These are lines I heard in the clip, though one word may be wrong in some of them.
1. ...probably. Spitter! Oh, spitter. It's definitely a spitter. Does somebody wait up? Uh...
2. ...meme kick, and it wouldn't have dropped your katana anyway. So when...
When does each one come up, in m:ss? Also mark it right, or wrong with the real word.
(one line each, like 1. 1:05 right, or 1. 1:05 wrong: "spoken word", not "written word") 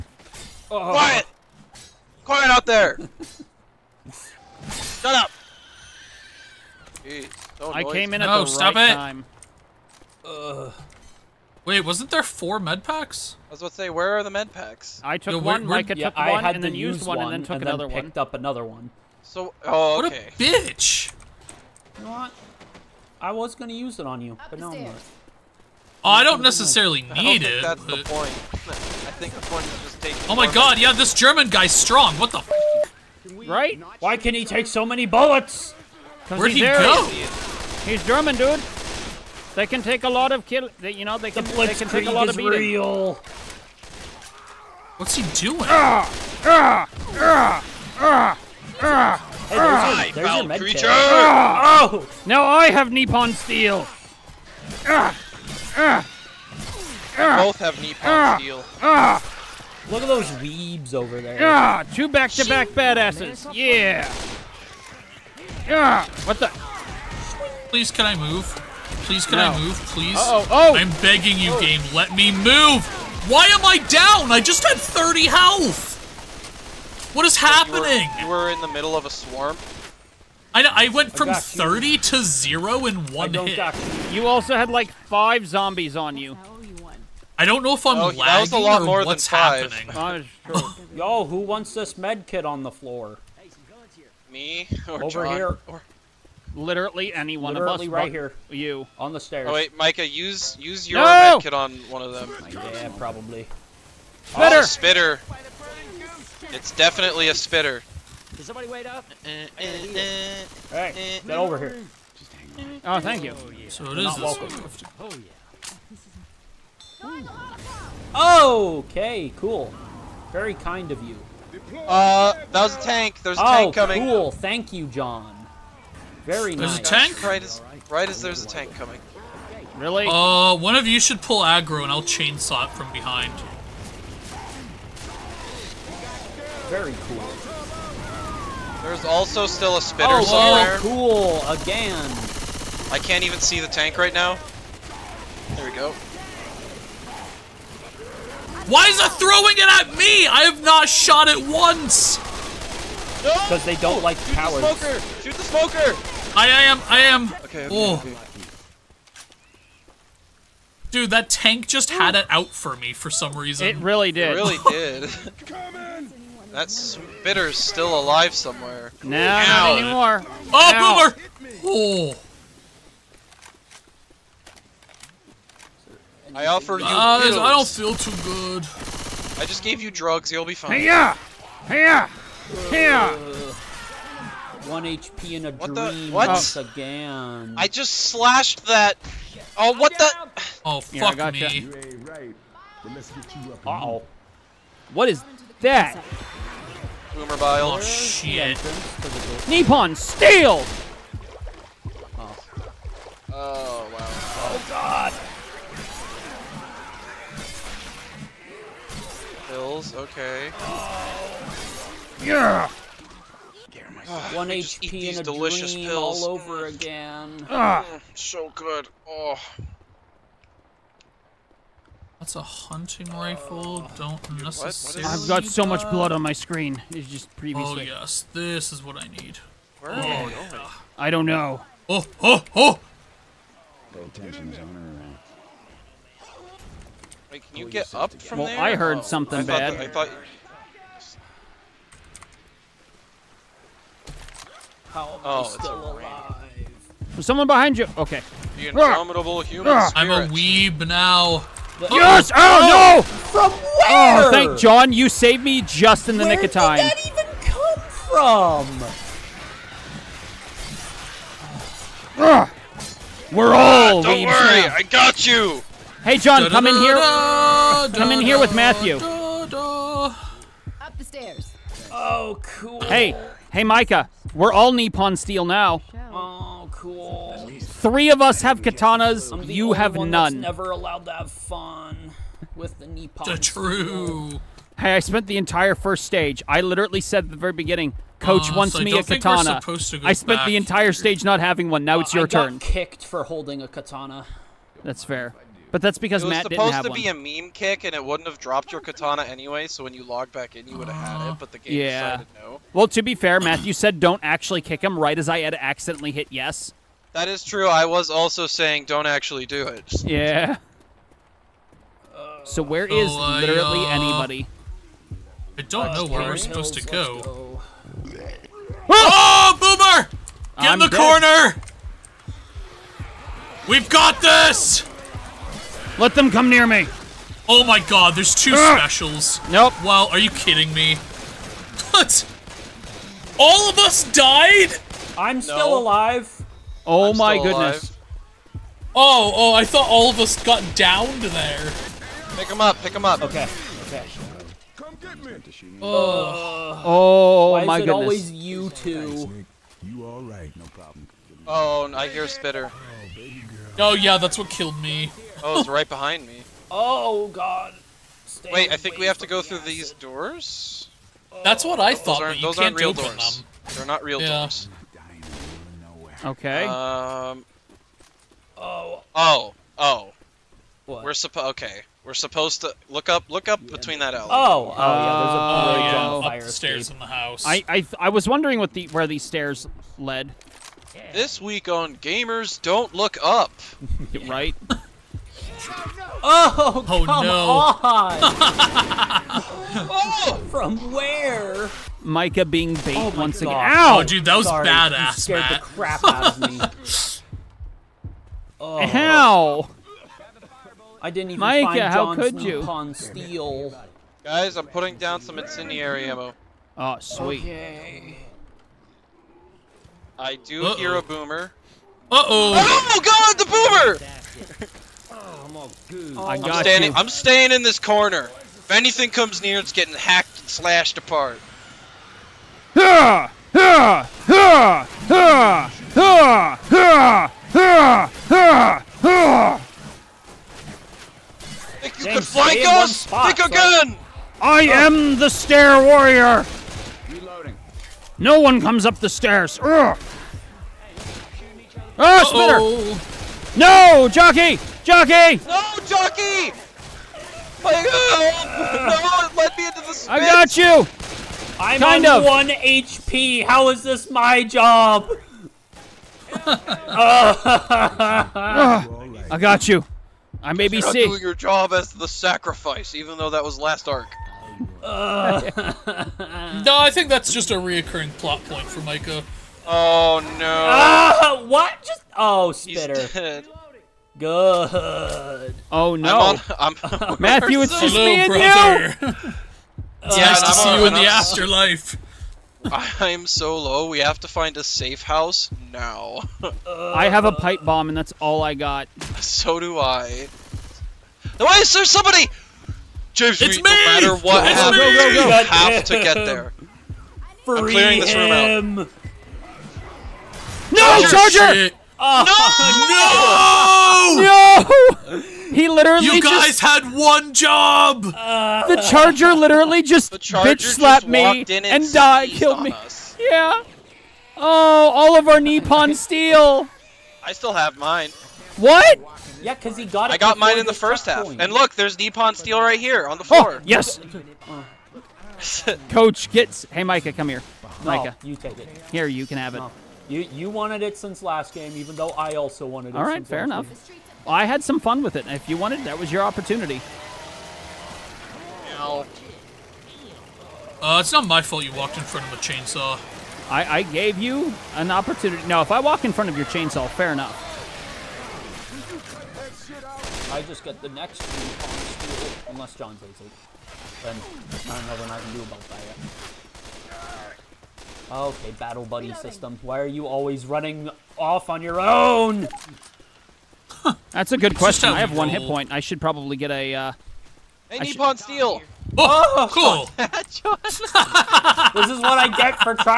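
1. 1:42 right
2. 4:57 right.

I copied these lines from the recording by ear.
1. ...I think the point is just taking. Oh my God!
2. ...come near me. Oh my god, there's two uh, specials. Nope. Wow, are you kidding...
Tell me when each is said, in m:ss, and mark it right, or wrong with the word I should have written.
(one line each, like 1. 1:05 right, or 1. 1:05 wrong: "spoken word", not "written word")
1. 0:28 right
2. 5:26 right.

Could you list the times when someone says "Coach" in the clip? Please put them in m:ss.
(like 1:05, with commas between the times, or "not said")
4:48, 8:45.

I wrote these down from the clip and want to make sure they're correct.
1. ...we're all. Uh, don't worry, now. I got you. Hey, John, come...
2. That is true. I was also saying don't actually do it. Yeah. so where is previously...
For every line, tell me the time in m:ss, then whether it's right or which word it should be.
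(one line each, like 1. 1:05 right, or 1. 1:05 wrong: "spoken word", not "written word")
1. 4:23 right
2. 5:07 wrong: "literally", not "previously".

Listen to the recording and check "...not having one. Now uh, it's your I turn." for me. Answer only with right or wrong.
right.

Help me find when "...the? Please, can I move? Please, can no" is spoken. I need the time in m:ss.
1:06.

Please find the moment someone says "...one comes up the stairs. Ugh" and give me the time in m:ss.
7:18.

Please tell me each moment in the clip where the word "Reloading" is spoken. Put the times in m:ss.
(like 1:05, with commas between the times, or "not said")
7:17, 9:19.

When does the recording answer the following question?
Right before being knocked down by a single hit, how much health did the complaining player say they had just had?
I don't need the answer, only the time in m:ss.
1:14.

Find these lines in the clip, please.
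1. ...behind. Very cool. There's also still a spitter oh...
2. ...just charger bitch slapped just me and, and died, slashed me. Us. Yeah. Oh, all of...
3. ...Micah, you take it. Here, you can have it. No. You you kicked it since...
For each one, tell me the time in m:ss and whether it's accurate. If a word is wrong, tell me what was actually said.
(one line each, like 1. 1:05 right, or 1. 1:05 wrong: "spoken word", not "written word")
1. 2:12 right
2. 8:29 wrong: "killed", not "slashed"
3. 8:47 wrong: "wanted", not "kicked".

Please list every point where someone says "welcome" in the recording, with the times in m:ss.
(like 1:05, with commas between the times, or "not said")
1:54.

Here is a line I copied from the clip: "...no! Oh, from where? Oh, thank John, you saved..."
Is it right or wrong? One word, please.
right.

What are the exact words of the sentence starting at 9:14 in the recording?
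Then I don't know what I can do about that yet.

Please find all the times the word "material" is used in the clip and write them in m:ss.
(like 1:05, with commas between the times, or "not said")
not said.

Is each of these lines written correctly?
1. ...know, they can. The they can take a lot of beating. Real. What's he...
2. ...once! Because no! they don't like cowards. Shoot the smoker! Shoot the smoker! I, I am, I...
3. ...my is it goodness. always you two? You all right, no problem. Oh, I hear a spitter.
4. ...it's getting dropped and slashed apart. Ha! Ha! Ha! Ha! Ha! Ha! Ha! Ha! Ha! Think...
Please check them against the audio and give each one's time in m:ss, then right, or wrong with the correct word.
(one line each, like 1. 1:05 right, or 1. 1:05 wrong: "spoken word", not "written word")
1. 0:41 right
2. 2:31 right
3. 5:47 right
4. 6:59 wrong: "hacked", not "dropped".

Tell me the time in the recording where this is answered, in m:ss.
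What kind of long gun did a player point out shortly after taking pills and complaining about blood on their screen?
3:42.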